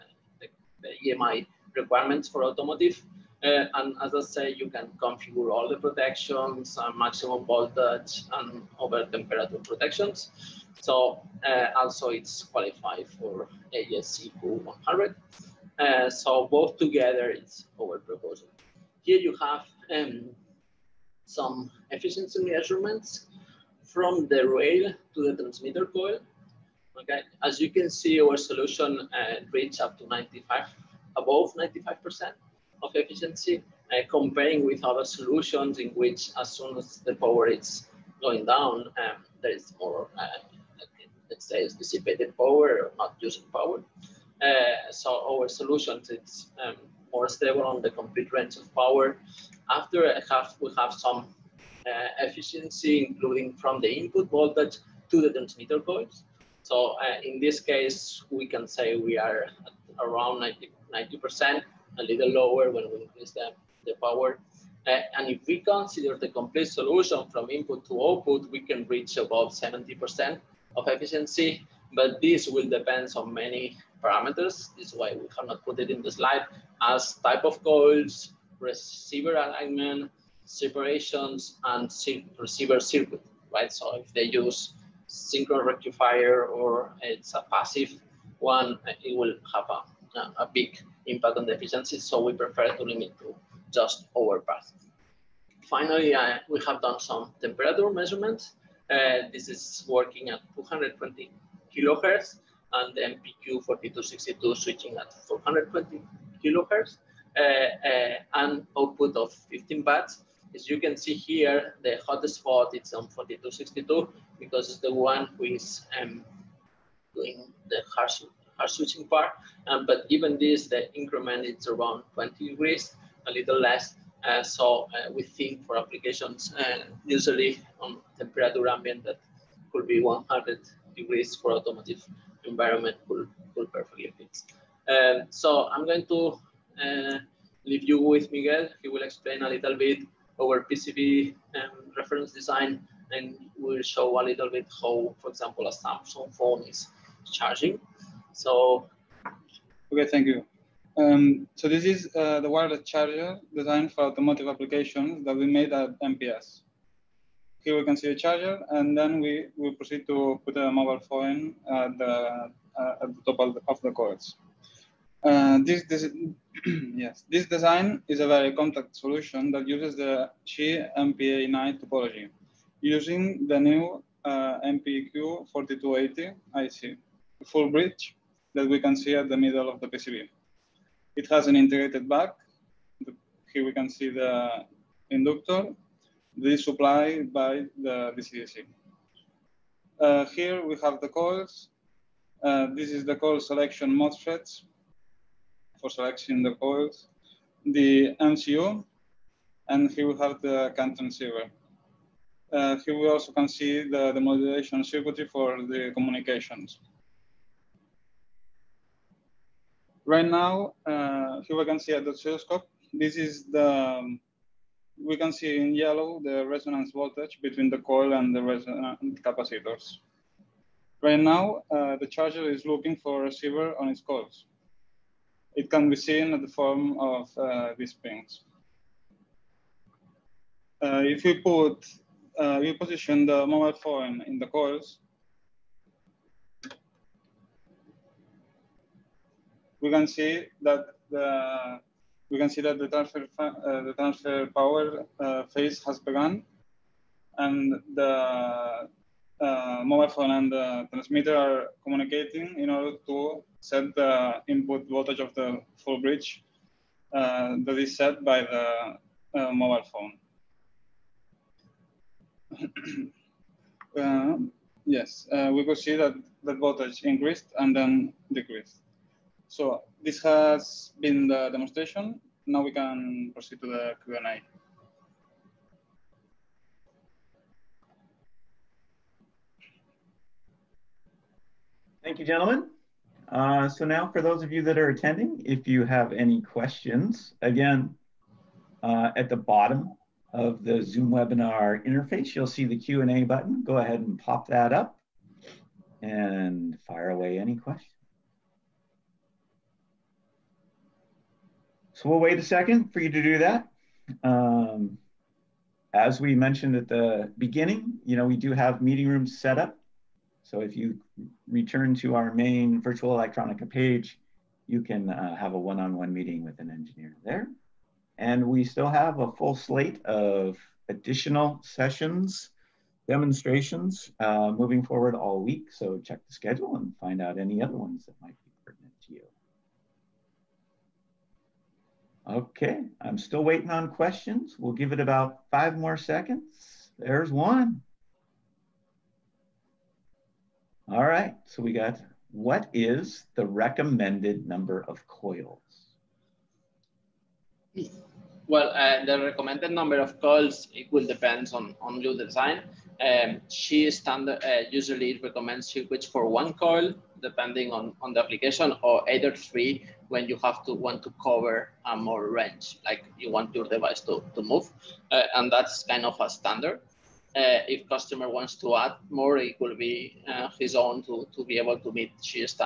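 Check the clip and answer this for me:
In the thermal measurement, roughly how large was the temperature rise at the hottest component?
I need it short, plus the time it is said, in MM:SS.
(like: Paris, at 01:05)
20 degrees, at 02:02.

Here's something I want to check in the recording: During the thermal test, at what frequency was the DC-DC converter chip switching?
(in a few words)
420 kHz.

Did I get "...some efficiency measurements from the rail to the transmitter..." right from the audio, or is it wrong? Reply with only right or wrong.
right.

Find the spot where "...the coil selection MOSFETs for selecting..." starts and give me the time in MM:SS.
03:13.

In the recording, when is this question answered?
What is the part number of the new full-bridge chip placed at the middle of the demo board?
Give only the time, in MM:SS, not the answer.
02:54.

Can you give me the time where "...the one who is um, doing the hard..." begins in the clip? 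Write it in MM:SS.
01:54.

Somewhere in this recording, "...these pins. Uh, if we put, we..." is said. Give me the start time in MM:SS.
03:47.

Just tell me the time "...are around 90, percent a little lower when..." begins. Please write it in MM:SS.
00:59.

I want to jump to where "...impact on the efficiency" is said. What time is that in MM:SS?
01:31.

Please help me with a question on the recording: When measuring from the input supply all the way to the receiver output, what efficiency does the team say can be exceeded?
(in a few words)
70%.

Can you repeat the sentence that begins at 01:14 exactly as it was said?
This is why we have not put it in the slide as type of coils, receiver alignment, separations, and receiver circuit, right?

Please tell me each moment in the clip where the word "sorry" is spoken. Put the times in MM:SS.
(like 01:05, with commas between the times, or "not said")
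not said.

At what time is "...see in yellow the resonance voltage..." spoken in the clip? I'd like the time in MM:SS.
03:35.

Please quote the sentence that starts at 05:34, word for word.
We'll give it about five more seconds.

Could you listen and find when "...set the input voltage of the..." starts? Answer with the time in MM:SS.
04:13.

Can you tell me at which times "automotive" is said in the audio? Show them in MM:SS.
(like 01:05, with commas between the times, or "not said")
00:02, 02:11, 02:34.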